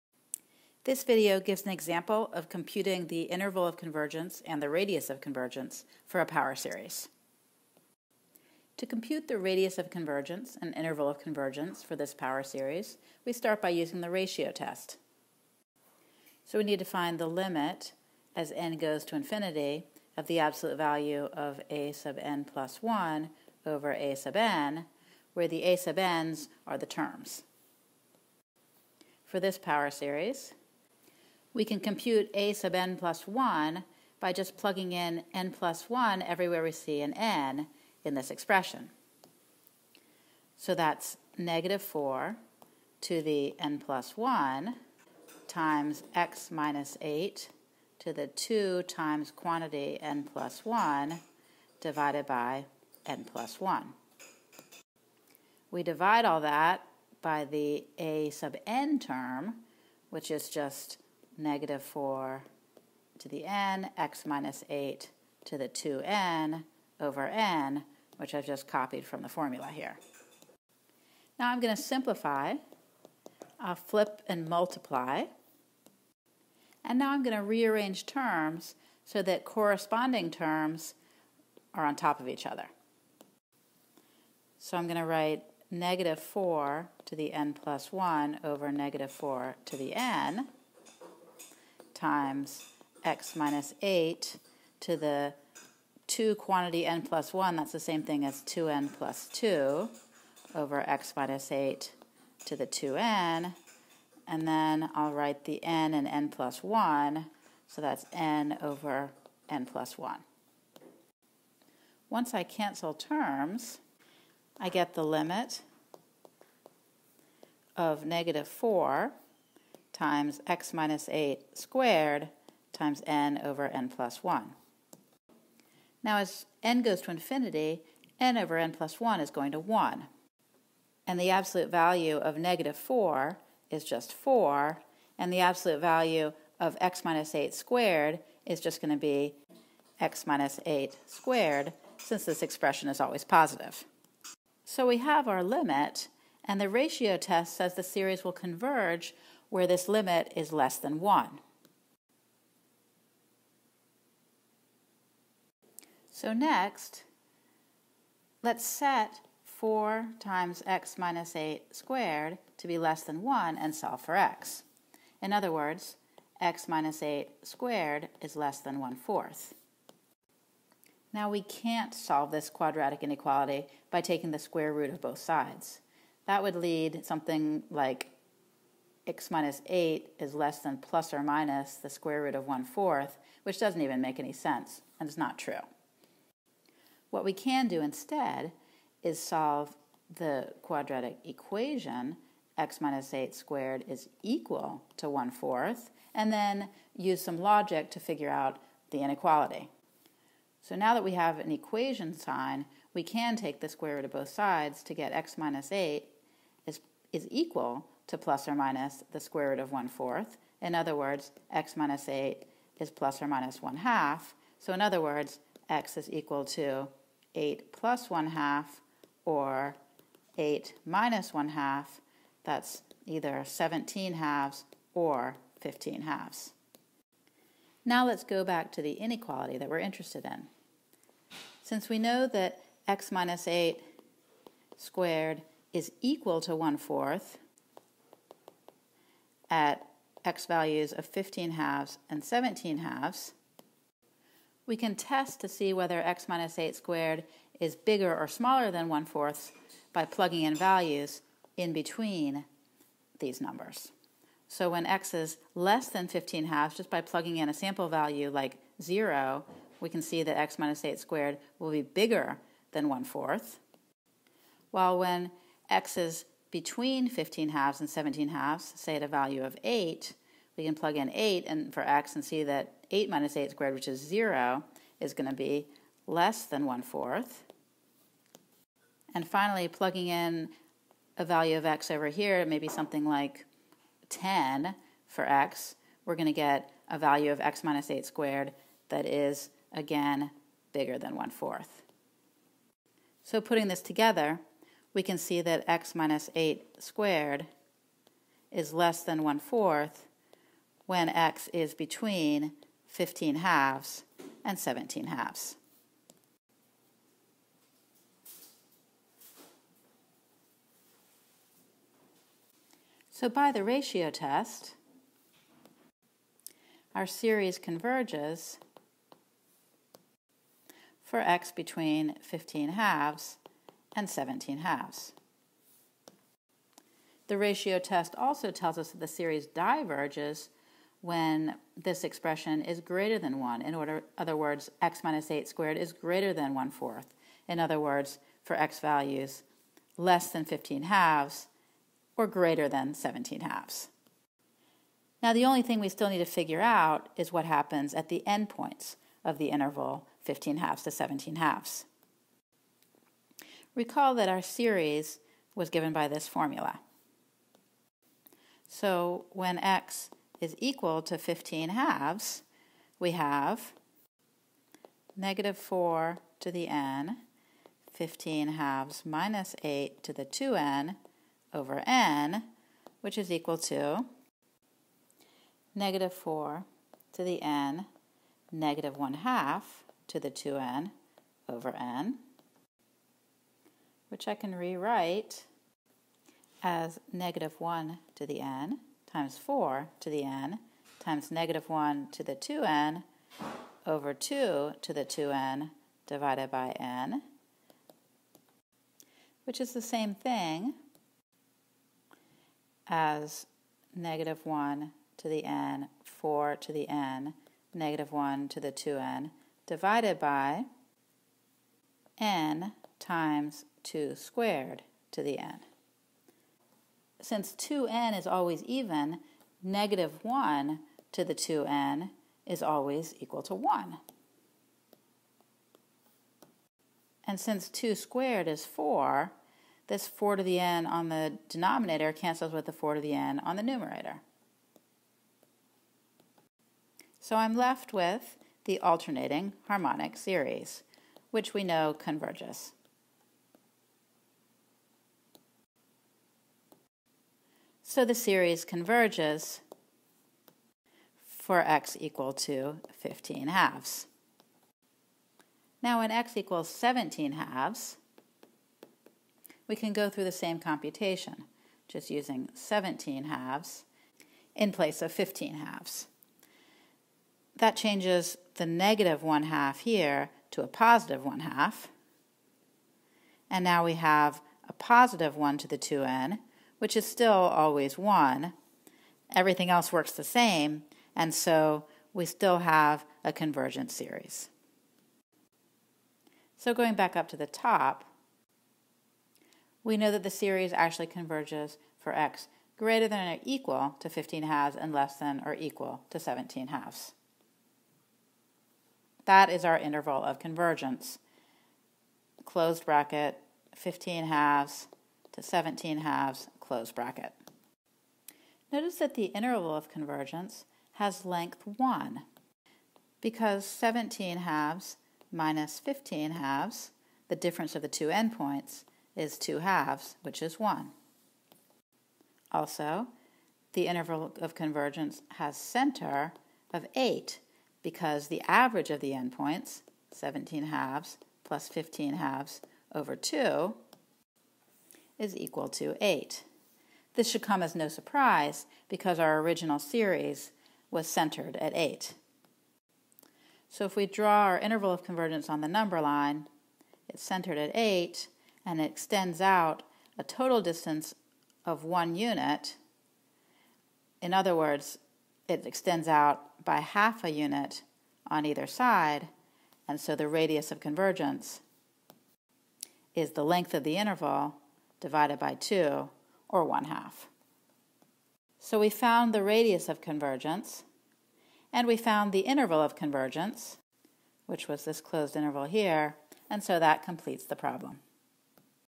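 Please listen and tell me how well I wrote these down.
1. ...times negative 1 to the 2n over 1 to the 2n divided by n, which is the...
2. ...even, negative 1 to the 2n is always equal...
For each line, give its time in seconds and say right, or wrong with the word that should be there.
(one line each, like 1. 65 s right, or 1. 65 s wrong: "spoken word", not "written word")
1. 390 s wrong: "2", not "1"
2. 418 s right.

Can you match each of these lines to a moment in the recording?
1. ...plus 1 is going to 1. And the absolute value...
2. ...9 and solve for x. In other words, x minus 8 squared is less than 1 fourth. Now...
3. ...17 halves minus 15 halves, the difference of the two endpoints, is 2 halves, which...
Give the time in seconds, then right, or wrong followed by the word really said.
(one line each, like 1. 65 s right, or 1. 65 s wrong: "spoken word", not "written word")
1. 128 s right
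2. 163 s wrong: "1", not "9"
3. 513 s right.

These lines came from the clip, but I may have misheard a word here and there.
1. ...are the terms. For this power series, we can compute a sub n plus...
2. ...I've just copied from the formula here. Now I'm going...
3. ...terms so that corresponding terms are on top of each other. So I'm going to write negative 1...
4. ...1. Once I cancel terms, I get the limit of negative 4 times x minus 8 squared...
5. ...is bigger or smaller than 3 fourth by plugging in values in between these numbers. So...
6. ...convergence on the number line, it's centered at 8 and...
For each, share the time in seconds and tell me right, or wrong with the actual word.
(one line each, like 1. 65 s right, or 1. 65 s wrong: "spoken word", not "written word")
1. 26 s right
2. 68 s right
3. 78 s wrong: "4", not "1"
4. 109 s right
5. 247 s wrong: "1", not "3"
6. 545 s right.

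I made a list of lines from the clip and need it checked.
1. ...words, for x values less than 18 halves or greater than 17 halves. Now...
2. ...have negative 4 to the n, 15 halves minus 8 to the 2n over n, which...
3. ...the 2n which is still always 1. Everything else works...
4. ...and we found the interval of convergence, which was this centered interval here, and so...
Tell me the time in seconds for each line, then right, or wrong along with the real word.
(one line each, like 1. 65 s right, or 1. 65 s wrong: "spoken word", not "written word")
1. 337 s wrong: "15", not "18"
2. 363 s right
3. 475 s right
4. 571 s wrong: "closed", not "centered".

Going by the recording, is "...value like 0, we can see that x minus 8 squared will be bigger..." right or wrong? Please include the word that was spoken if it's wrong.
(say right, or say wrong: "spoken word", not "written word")
right.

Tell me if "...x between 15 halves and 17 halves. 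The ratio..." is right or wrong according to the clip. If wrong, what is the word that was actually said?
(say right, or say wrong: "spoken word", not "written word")
right.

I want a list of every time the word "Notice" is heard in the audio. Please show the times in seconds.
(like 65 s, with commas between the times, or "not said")
508 s.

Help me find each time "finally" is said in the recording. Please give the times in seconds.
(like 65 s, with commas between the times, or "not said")
279 s.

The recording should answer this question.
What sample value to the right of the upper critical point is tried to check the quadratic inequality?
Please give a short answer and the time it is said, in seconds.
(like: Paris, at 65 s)
10, at 284 s.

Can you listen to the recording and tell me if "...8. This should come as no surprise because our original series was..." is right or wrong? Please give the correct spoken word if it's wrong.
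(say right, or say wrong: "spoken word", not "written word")
right.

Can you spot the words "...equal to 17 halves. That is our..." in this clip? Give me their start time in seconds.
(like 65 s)
495 s.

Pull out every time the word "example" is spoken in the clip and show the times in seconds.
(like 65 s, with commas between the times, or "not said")
1 s.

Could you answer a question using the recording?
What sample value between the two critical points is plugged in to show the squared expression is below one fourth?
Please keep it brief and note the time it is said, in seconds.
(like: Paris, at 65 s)
8, at 269 s.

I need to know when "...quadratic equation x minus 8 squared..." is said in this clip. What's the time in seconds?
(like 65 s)
190 s.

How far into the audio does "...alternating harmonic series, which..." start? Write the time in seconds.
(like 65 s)
438 s.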